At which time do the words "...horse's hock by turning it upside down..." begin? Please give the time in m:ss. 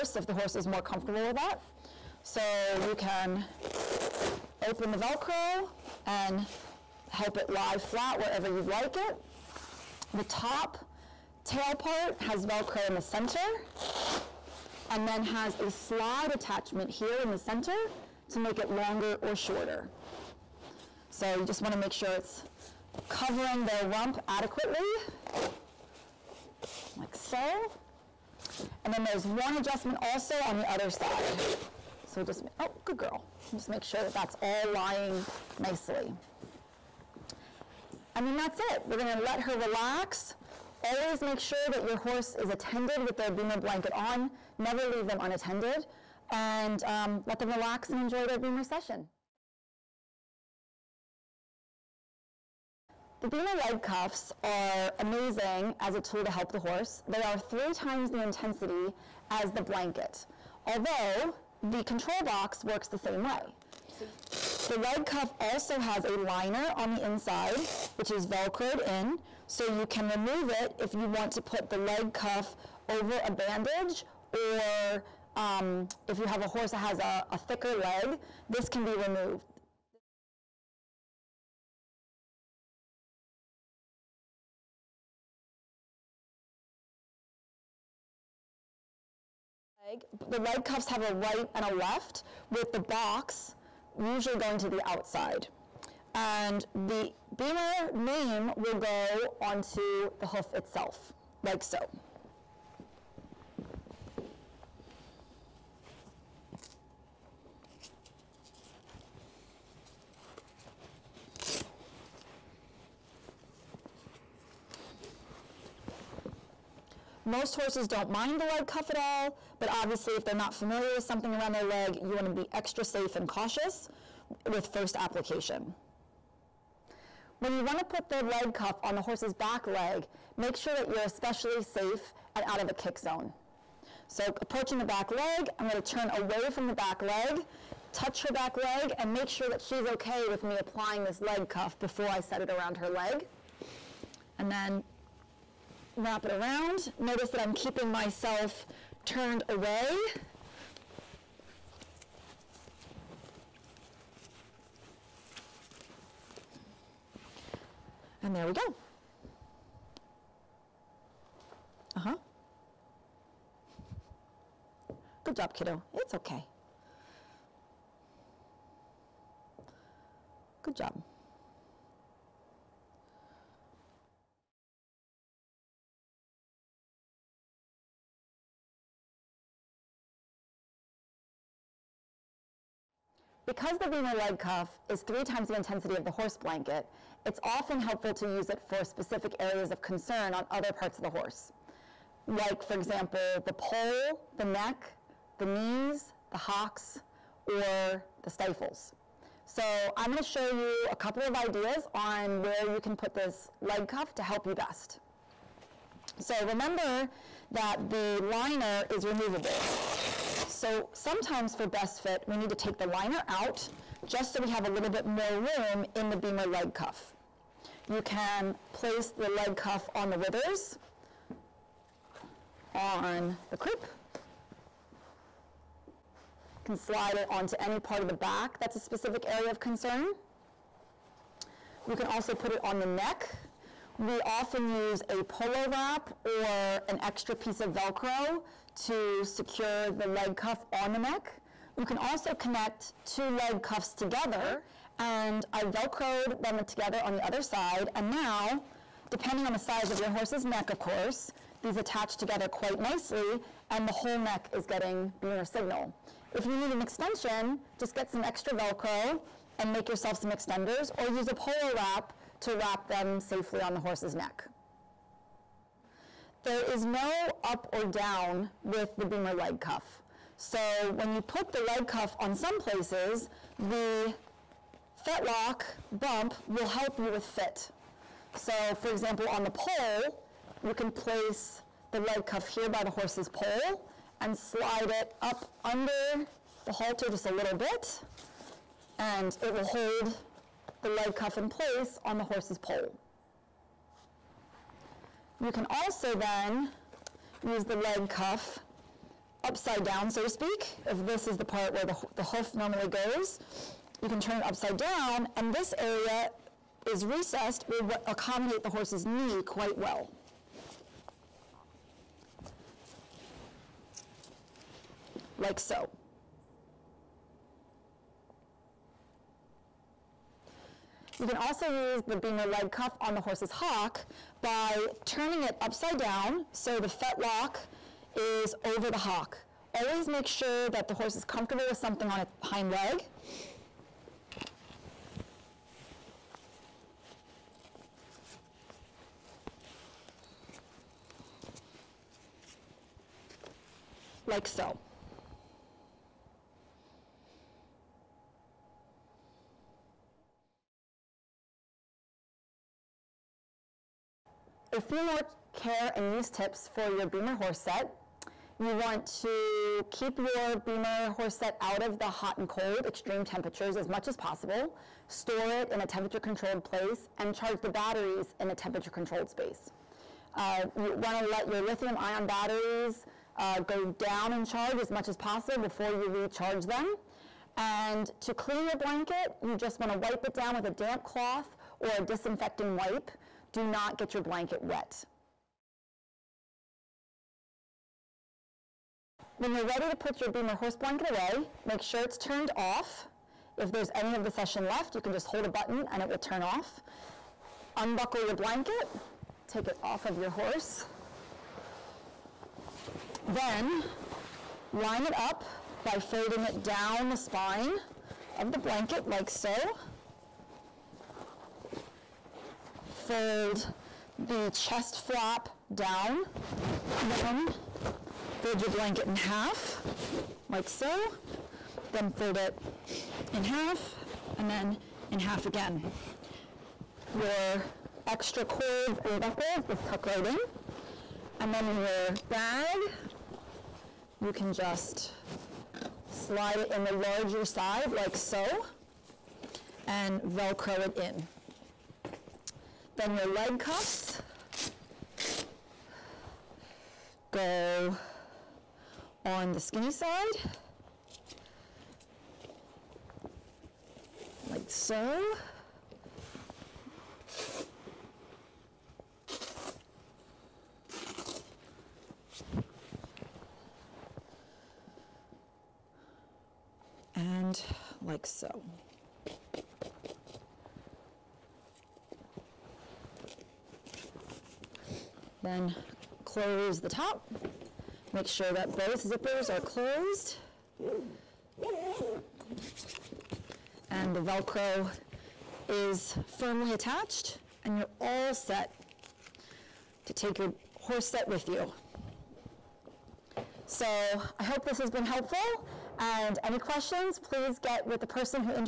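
5:23.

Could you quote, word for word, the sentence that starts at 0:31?
So we'll just, oh, good girl.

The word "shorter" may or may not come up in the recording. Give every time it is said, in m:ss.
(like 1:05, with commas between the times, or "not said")
0:19.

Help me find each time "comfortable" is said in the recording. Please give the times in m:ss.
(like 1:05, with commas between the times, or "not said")
0:00, 5:31.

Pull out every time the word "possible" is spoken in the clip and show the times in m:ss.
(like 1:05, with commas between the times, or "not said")
6:04, 6:15.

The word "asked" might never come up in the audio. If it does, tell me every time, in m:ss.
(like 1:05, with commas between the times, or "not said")
not said.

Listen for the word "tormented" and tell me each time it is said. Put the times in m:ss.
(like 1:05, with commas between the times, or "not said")
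not said.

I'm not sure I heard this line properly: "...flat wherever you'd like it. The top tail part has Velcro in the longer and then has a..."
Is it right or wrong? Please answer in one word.
wrong.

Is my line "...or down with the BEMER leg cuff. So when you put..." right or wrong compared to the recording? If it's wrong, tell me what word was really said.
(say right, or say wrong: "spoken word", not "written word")
right.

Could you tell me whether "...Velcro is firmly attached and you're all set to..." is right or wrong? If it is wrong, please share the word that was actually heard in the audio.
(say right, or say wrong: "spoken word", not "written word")
right.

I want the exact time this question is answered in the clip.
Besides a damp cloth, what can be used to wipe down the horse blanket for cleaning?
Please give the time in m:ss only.
6:22.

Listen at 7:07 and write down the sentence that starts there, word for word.
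Your extra cords and buckles just tuck right in.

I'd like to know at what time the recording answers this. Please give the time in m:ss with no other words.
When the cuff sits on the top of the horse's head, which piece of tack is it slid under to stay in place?
4:46.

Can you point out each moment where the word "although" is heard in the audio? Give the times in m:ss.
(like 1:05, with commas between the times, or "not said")
1:00.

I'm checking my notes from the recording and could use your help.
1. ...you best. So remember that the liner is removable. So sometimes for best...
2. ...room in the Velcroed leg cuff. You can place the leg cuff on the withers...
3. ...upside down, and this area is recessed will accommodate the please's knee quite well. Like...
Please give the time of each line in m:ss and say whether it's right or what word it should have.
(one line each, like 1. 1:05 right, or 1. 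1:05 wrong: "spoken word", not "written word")
1. 3:24 right
2. 3:35 wrong: "BEMER", not "Velcroed"
3. 5:04 wrong: "horse", not "please".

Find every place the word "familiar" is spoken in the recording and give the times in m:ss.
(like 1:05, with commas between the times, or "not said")
2:00.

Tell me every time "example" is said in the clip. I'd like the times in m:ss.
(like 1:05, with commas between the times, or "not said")
3:12, 4:38.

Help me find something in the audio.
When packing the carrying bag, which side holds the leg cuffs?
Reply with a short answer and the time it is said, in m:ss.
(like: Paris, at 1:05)
The skinny side, at 7:29.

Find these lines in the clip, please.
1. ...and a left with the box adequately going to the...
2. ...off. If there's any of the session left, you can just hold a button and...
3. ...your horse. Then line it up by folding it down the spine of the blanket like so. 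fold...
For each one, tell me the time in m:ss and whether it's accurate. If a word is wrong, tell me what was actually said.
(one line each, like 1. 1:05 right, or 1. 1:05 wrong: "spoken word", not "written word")
1. 1:31 wrong: "usually", not "adequately"
2. 6:32 right
3. 6:40 right.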